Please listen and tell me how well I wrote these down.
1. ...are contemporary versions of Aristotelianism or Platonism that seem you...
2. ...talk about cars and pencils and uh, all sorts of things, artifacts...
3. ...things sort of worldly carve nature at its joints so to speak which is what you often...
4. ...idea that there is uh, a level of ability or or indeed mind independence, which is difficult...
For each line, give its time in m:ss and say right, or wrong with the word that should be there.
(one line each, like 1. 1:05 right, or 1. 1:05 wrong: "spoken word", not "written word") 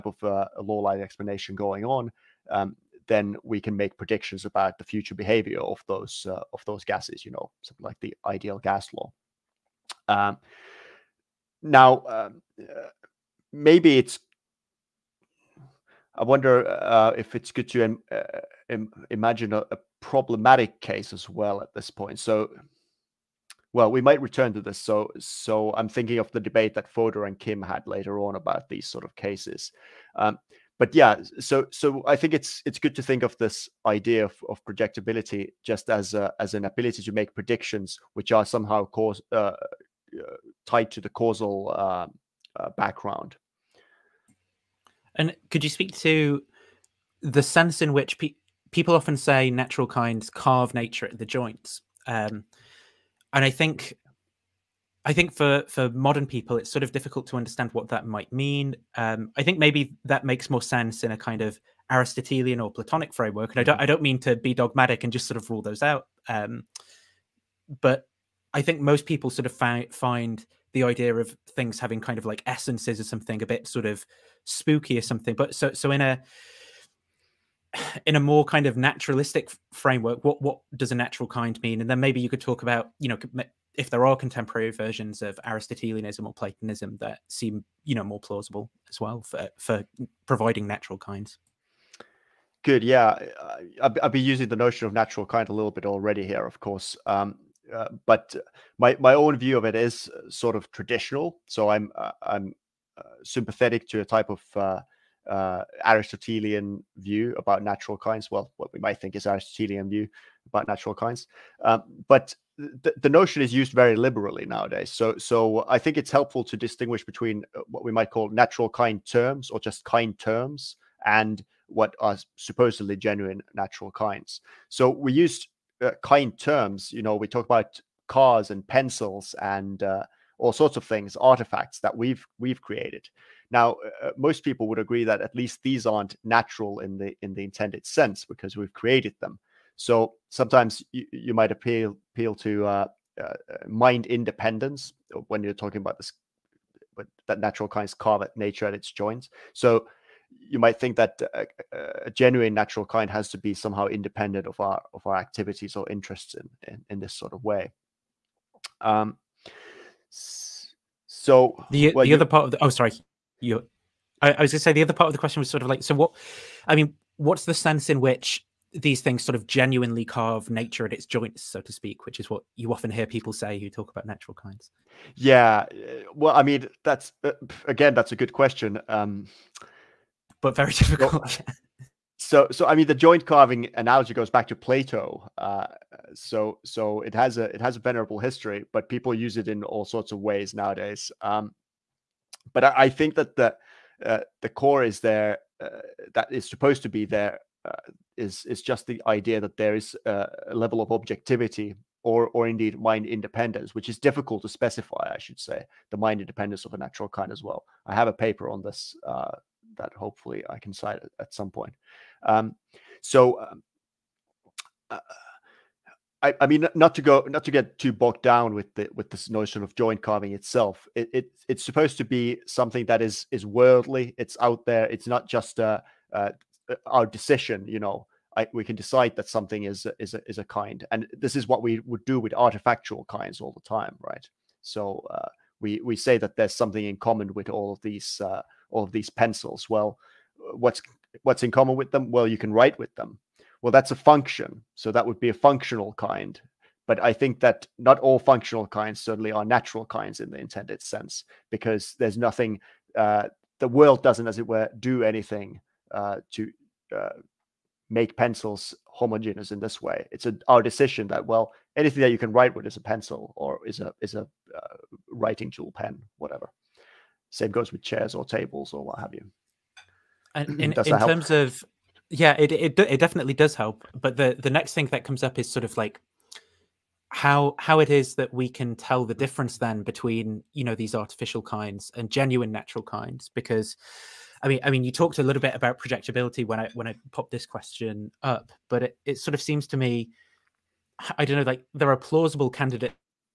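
1. 1:24 right
2. 2:07 right
3. 2:49 wrong: "genuinely", not "worldly"
4. 3:19 wrong: "objectivity", not "ability".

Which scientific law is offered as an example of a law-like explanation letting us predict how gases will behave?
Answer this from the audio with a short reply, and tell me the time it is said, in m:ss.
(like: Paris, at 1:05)
the ideal gas law, at 0:07.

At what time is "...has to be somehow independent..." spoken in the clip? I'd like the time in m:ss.
2:33.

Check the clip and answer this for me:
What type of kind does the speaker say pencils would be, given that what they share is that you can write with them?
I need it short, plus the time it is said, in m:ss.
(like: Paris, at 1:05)
a functional kind, at 4:05.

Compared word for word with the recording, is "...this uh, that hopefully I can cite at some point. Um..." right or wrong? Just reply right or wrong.
right.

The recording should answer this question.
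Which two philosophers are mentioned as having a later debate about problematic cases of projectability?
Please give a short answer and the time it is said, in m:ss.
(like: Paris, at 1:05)
Fodor and Kim, at 0:26.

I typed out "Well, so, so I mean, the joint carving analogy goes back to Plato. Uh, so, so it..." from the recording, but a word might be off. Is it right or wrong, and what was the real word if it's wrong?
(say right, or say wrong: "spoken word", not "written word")
right.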